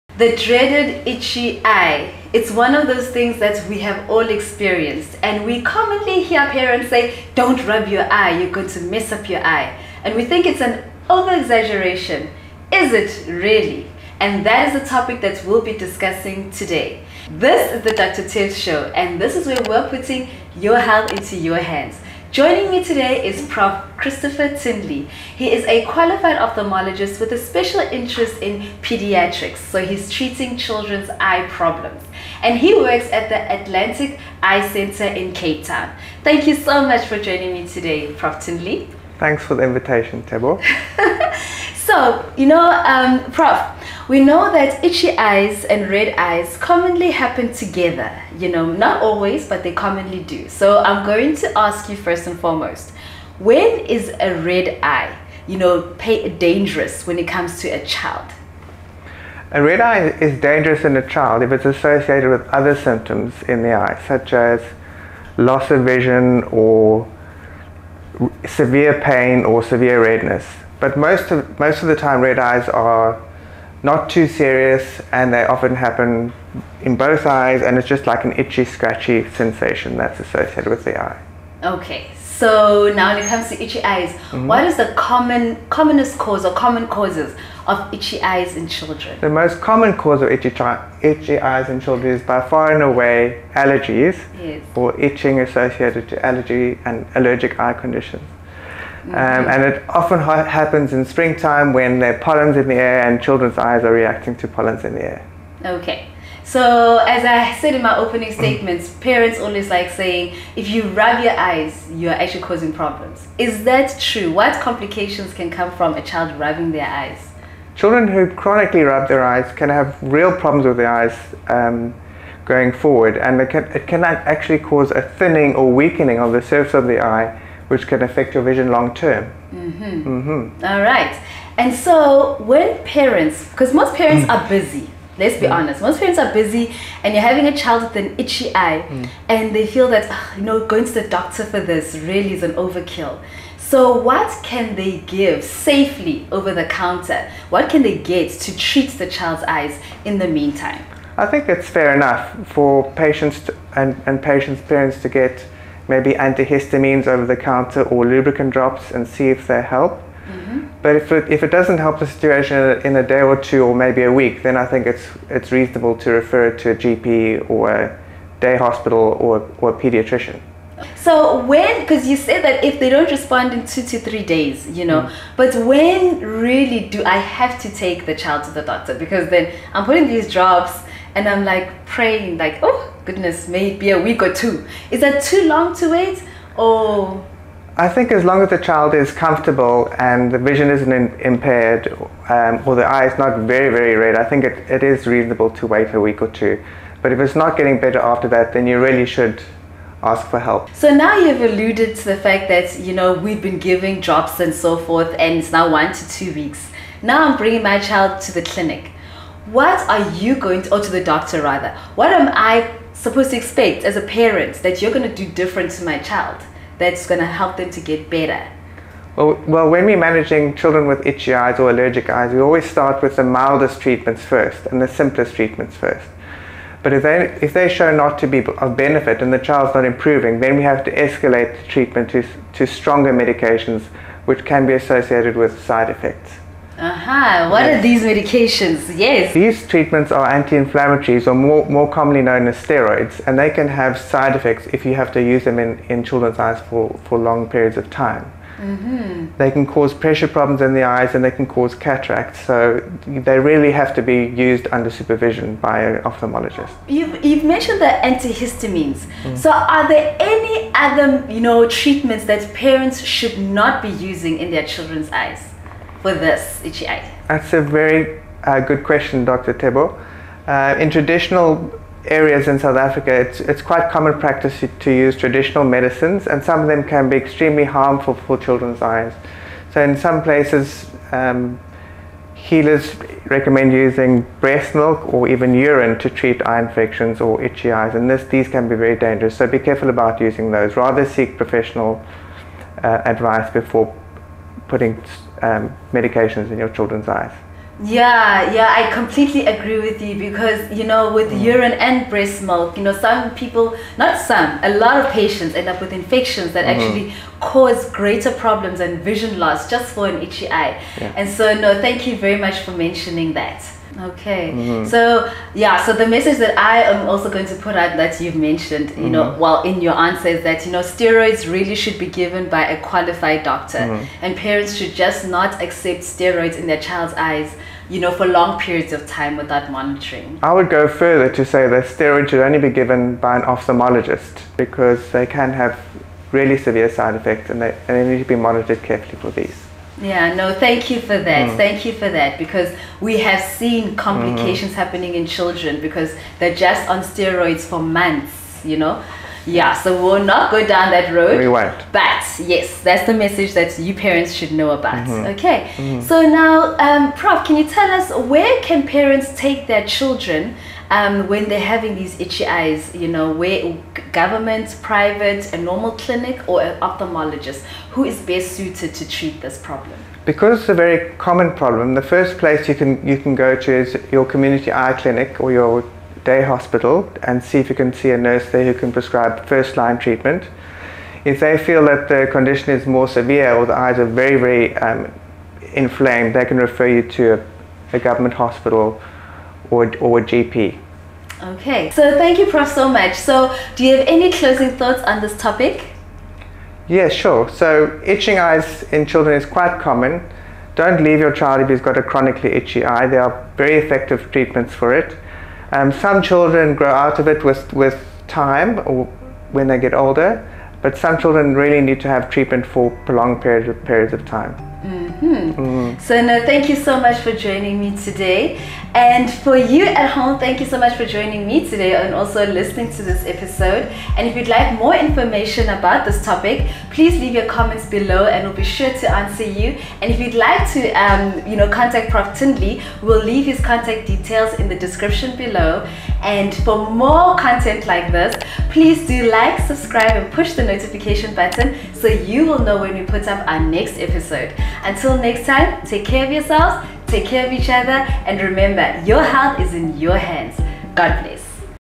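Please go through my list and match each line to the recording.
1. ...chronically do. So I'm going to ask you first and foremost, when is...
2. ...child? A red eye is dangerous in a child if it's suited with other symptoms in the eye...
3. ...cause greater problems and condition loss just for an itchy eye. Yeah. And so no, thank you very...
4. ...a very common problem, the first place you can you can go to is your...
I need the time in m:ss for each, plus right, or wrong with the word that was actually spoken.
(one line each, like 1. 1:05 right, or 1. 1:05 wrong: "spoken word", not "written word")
1. 0:49 wrong: "commonly", not "chronically"
2. 0:57 wrong: "associated", not "suited"
3. 5:07 wrong: "vision", not "condition"
4. 6:10 right.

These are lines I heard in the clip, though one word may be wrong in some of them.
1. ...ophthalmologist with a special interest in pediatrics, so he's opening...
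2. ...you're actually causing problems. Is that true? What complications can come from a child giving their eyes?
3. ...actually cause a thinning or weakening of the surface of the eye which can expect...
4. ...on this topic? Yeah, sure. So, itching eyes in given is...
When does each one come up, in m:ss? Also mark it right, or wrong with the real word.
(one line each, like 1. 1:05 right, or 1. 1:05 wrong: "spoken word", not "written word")
1. 0:26 wrong: "treating", not "opening"
2. 1:51 wrong: "rubbing", not "giving"
3. 2:04 wrong: "affect", not "expect"
4. 6:35 wrong: "children", not "given".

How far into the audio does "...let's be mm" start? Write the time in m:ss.
2:15.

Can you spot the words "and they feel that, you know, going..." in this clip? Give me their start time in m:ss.
2:19.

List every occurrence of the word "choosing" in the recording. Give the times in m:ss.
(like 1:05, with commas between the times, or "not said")
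not said.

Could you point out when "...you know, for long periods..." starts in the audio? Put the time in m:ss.
5:27.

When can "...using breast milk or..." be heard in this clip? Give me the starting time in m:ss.
4:43.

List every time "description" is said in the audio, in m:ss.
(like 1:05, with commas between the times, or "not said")
7:14.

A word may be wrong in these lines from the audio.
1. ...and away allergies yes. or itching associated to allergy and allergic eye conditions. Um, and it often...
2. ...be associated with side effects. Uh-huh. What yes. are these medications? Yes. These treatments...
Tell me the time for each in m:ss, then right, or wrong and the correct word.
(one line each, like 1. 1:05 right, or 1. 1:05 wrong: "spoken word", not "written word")
1. 1:32 right
2. 3:54 right.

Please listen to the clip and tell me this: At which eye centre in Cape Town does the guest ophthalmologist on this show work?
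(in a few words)
Atlantic Eye Center.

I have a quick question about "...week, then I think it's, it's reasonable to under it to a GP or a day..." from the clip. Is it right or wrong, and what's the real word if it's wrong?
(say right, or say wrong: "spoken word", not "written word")
wrong: "refer", not "under".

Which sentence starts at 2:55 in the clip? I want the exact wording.
but when really do I have to take the child to the doctor?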